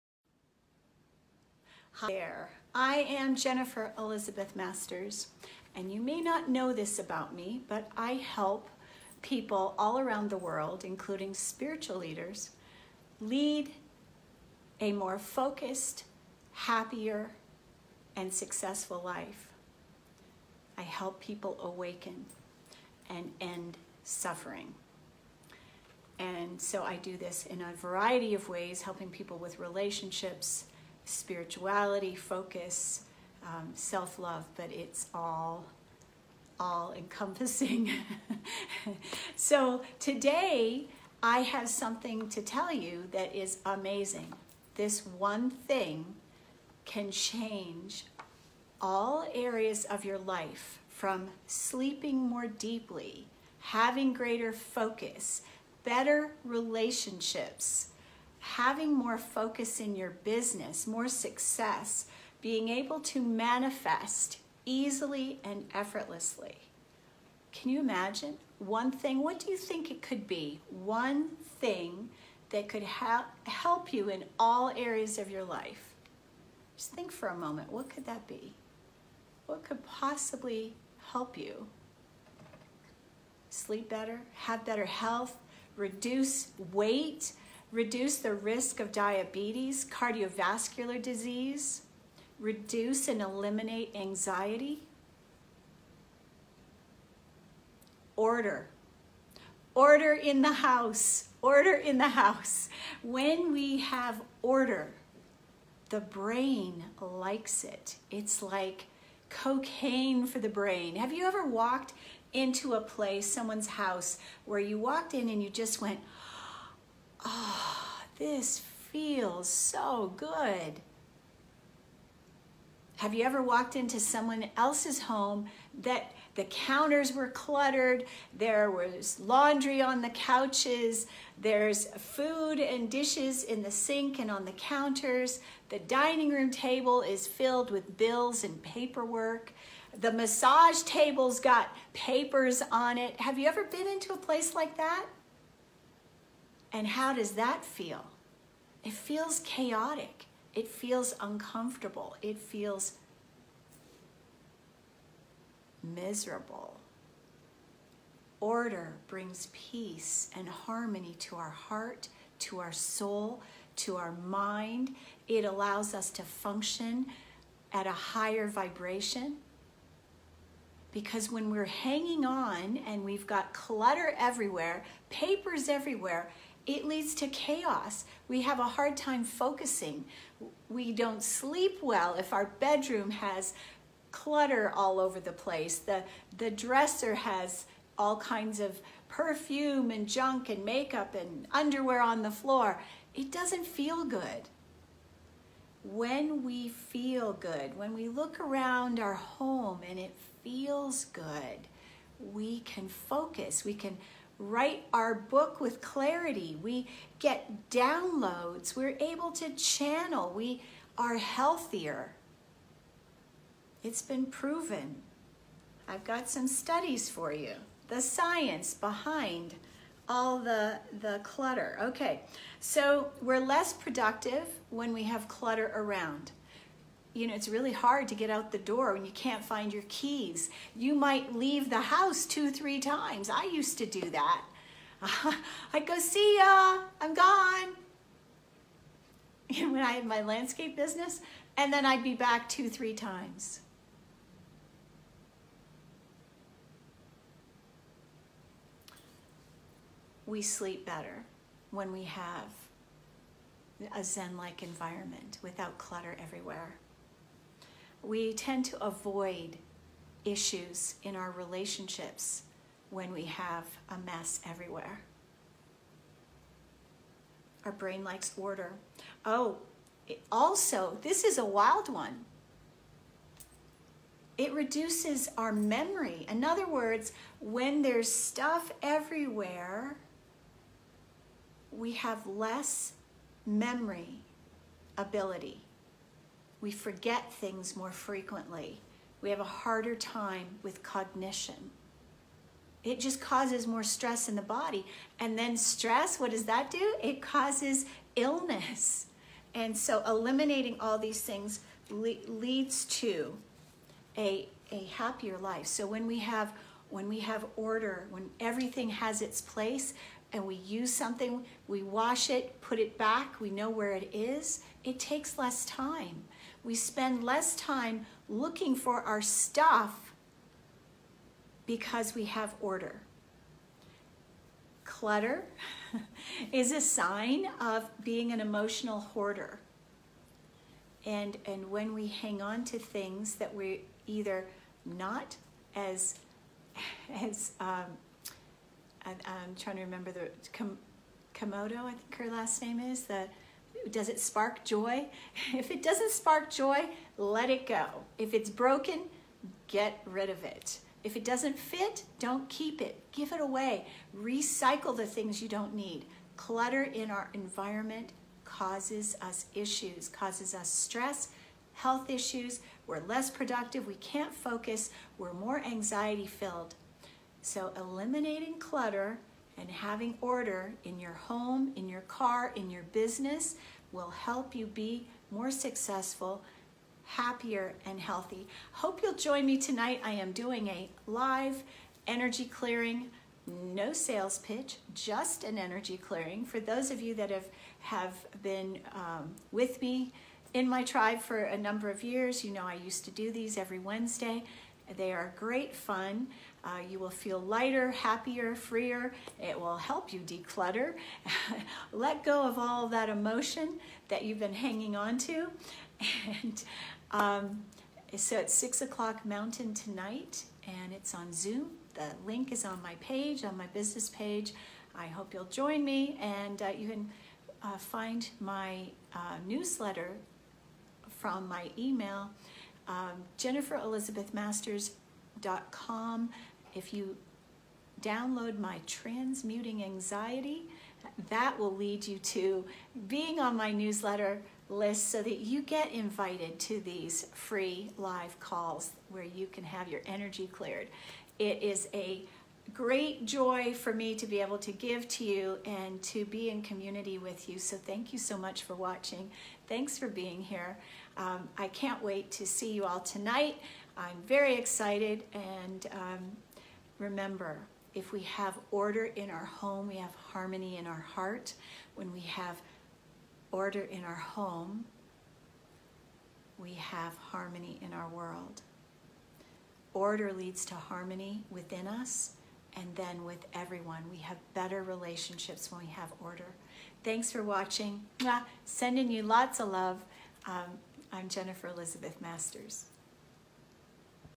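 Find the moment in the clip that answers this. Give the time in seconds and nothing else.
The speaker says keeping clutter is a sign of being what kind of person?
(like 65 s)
328 s.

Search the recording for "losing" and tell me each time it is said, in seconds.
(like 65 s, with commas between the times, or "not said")
not said.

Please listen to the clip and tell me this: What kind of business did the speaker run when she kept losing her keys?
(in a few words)
Landscape business.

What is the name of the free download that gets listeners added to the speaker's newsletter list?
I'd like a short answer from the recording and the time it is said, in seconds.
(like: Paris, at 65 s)
Transmuting Anxiety, at 428 s.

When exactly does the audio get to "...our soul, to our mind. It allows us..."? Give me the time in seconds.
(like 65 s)
162 s.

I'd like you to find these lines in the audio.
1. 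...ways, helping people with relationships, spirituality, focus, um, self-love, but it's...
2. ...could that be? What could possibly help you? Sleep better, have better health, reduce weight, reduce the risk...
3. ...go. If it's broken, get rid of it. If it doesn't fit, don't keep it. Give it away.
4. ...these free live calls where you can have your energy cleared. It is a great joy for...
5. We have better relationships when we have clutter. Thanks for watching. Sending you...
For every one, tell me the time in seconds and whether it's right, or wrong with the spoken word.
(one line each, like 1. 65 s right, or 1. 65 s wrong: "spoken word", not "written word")
1. 28 s right
2. 77 s right
3. 347 s right
4. 436 s right
5. 474 s wrong: "order", not "clutter".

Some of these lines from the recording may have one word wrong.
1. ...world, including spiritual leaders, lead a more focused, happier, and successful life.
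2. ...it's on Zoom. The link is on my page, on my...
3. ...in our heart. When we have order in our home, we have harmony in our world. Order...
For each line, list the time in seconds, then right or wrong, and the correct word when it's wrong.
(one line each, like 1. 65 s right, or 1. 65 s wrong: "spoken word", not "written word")
1. 10 s right
2. 410 s right
3. 460 s right.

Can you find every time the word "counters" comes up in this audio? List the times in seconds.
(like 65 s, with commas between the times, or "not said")
126 s, 134 s.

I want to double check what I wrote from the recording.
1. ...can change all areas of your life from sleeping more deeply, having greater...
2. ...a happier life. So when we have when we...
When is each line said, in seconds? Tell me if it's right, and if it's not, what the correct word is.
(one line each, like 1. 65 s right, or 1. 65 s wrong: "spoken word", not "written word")
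1. 46 s right
2. 304 s right.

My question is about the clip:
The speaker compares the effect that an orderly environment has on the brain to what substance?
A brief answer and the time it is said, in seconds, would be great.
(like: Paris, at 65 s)
Cocaine, at 109 s.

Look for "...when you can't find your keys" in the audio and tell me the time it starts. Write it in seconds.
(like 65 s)
228 s.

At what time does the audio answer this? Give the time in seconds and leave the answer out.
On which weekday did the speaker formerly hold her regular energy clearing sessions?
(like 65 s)
393 s.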